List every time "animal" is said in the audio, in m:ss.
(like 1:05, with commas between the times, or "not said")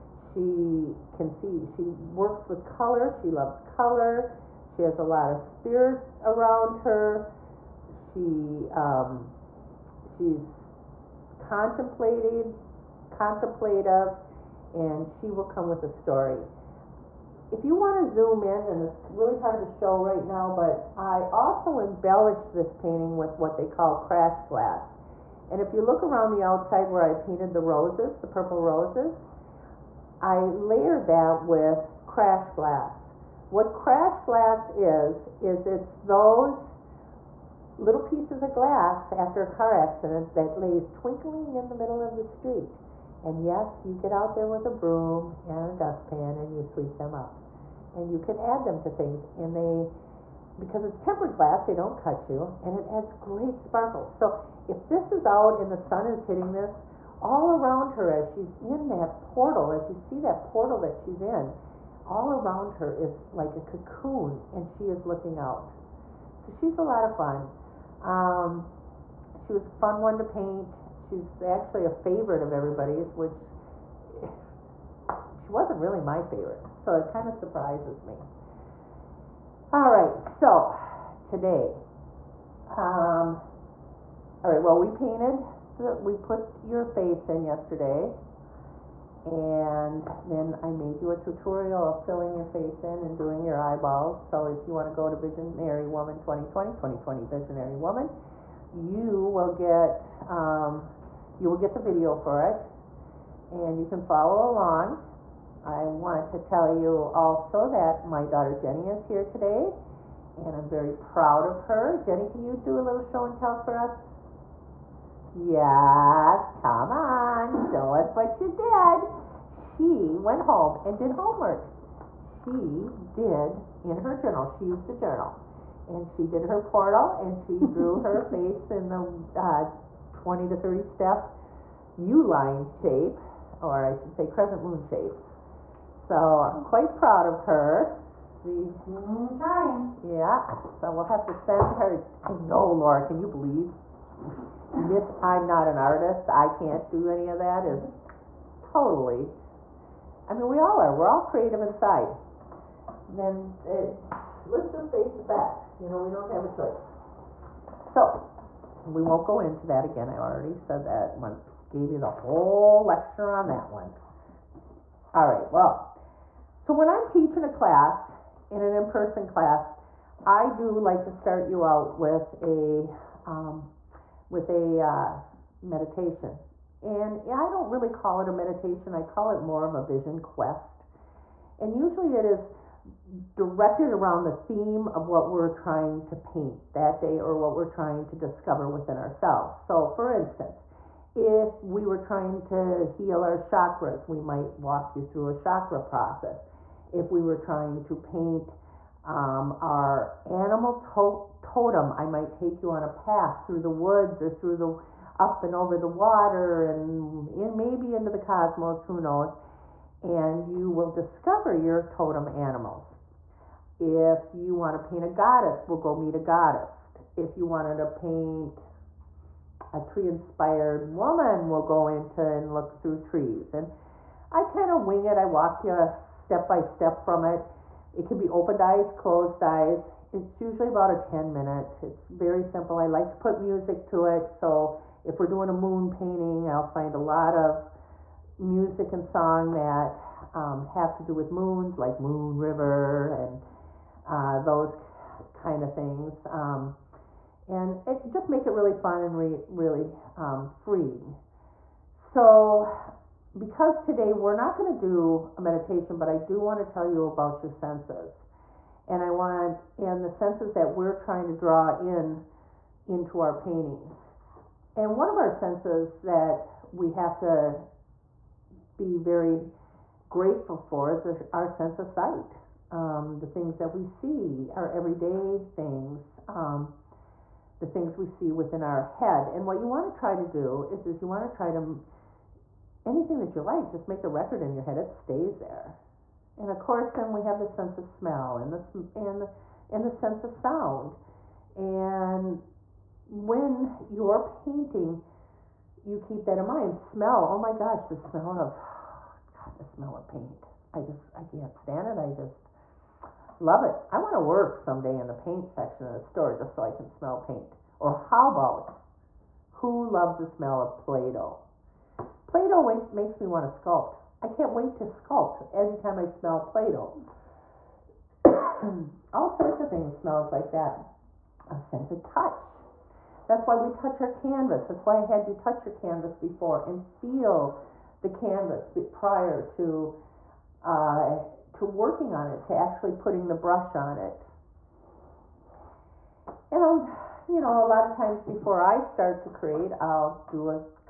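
3:20, 3:32.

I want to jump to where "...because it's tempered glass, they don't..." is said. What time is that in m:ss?
0:50.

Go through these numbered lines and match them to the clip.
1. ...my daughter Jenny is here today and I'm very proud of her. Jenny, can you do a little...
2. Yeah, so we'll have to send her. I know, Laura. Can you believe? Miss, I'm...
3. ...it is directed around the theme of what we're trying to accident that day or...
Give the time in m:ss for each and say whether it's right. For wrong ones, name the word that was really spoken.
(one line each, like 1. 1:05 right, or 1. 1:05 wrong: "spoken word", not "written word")
1. 1:48 right
2. 2:20 right
3. 3:02 wrong: "paint", not "accident".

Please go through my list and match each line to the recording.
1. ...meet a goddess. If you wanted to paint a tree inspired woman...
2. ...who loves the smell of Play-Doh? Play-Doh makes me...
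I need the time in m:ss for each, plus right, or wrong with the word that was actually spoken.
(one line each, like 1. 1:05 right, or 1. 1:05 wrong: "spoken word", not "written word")
1. 3:35 right
2. 5:09 right.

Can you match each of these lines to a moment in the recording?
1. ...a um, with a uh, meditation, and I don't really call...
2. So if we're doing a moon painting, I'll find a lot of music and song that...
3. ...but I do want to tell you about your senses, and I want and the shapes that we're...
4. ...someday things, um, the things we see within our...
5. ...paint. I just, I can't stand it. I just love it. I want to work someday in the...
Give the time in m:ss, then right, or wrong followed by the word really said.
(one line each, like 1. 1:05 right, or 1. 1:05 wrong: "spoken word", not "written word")
1. 2:52 right
2. 3:54 right
3. 4:15 wrong: "senses", not "shapes"
4. 4:34 wrong: "everyday", not "someday"
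5. 5:00 right.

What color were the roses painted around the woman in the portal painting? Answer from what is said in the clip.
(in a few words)
purple.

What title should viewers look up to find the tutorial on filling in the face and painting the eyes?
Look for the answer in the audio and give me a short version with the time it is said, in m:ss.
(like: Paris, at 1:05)
Visionary Woman 2020, at 1:35.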